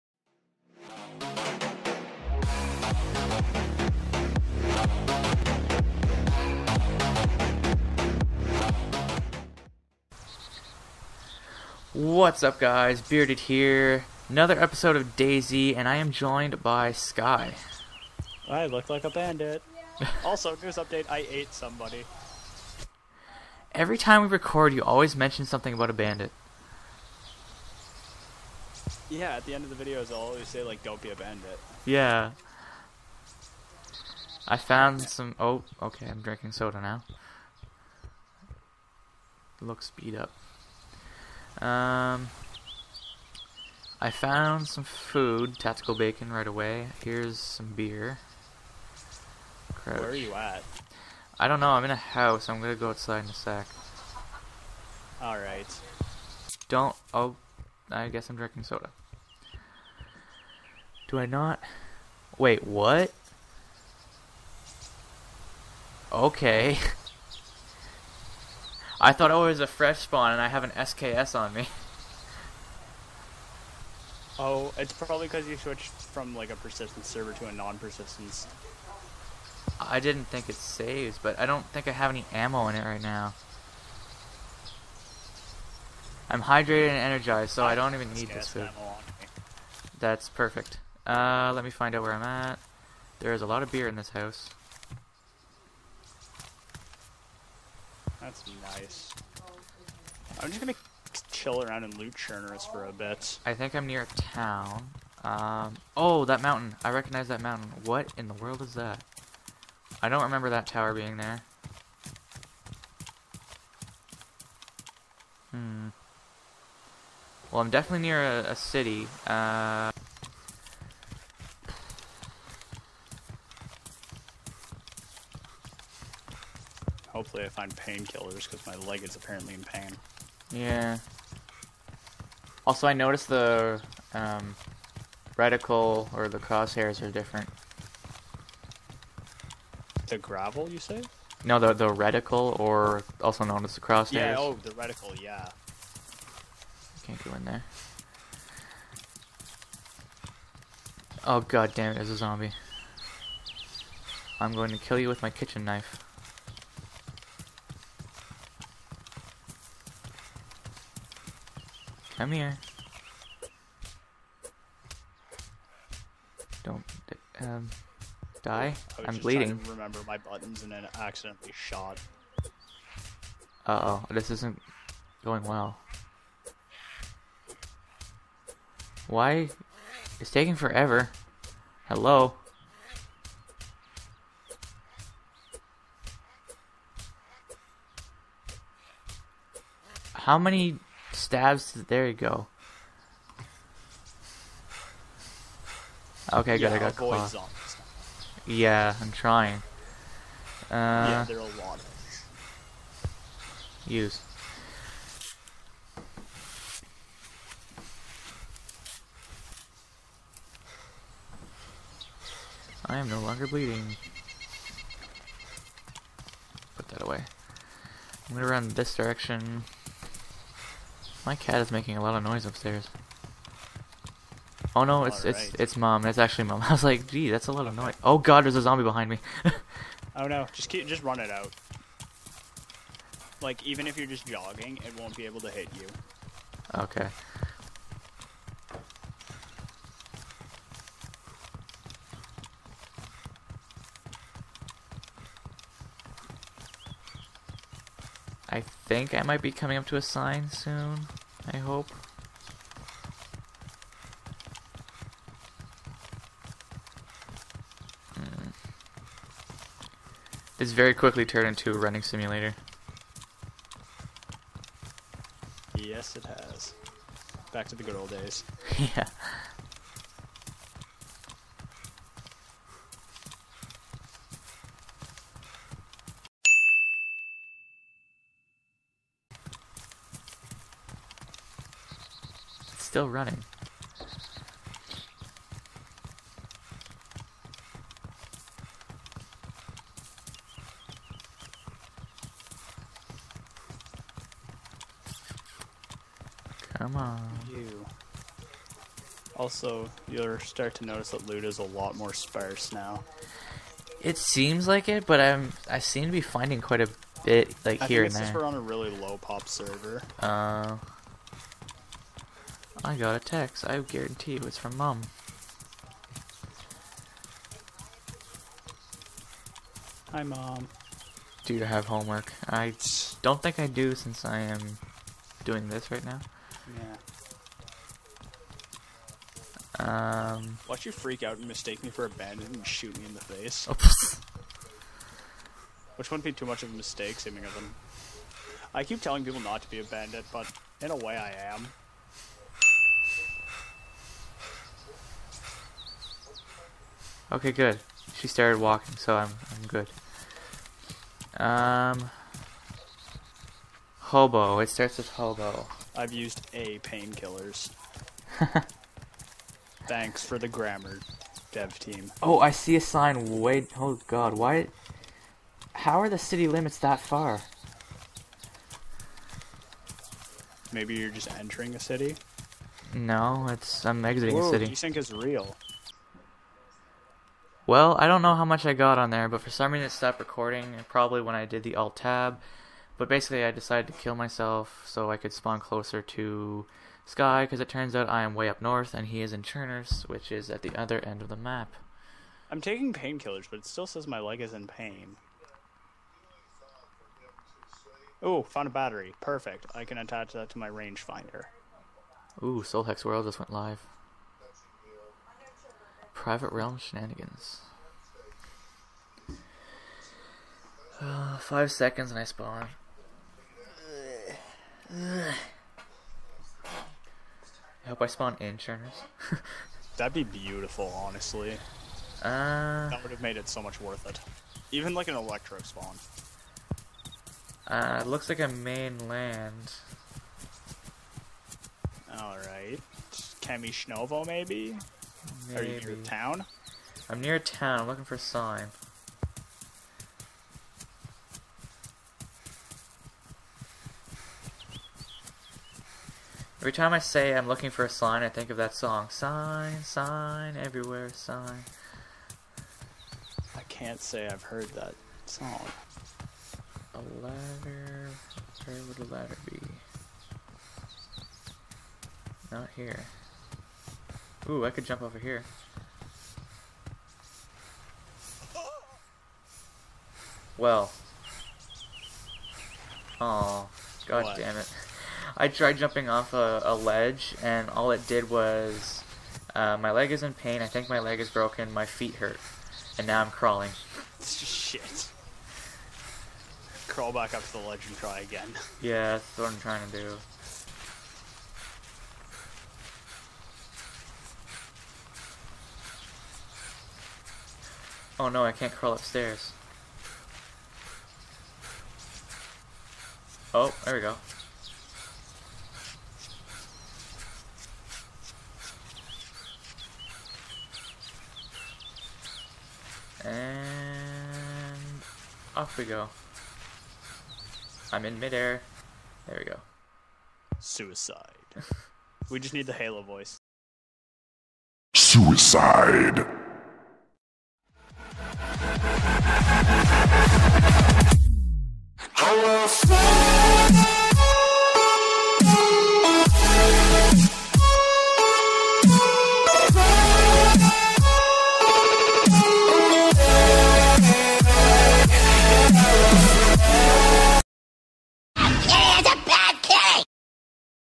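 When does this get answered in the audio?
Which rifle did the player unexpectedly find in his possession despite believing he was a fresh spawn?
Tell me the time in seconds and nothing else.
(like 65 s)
70 s.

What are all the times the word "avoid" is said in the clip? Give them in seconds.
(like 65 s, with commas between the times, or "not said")
196 s.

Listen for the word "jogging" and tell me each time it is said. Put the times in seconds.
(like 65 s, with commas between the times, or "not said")
234 s.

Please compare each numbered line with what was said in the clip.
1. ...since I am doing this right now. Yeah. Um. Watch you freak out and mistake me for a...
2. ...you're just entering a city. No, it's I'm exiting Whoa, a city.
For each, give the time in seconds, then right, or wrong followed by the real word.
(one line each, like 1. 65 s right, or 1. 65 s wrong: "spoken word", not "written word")
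1. 323 s right
2. 370 s right.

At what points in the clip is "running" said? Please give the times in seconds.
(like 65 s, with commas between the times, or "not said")
261 s, 283 s.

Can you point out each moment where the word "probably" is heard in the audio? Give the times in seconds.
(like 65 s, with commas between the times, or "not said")
74 s, 380 s.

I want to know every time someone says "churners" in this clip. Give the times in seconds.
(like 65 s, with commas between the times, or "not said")
102 s, 389 s, 418 s.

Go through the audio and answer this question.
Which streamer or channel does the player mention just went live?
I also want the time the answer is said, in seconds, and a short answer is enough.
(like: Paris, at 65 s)
Hex World, at 402 s.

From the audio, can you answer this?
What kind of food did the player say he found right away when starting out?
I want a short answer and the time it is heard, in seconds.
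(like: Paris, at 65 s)
tactical bacon, at 45 s.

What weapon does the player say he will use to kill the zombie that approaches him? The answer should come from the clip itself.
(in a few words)
kitchen knife.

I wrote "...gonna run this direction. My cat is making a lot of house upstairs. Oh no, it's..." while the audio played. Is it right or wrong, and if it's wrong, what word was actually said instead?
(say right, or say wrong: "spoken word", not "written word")
wrong: "noise", not "house".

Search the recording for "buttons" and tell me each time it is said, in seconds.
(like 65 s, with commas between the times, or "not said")
170 s.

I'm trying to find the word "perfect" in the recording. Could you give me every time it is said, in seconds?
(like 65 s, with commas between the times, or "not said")
90 s, 399 s.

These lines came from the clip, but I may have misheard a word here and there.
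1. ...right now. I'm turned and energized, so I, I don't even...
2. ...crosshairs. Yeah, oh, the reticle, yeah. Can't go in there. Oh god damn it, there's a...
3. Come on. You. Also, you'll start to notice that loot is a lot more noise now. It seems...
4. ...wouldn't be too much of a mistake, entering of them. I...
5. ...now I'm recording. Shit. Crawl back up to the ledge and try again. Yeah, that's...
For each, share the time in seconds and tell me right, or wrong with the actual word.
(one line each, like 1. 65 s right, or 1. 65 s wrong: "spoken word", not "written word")
1. 82 s wrong: "hydrated", not "turned"
2. 143 s right
3. 296 s wrong: "sparse", not "noise"
4. 336 s wrong: "seeming", not "entering"
5. 483 s wrong: "crawling", not "recording".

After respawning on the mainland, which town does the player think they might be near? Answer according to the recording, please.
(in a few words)
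Kamyshovo.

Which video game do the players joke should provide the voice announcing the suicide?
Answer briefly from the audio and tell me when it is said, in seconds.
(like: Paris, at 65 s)
Halo, at 522 s.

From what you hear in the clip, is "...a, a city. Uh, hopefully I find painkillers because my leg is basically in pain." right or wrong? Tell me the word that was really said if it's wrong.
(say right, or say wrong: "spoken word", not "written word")
wrong: "apparently", not "basically".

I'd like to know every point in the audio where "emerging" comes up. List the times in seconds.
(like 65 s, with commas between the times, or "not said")
not said.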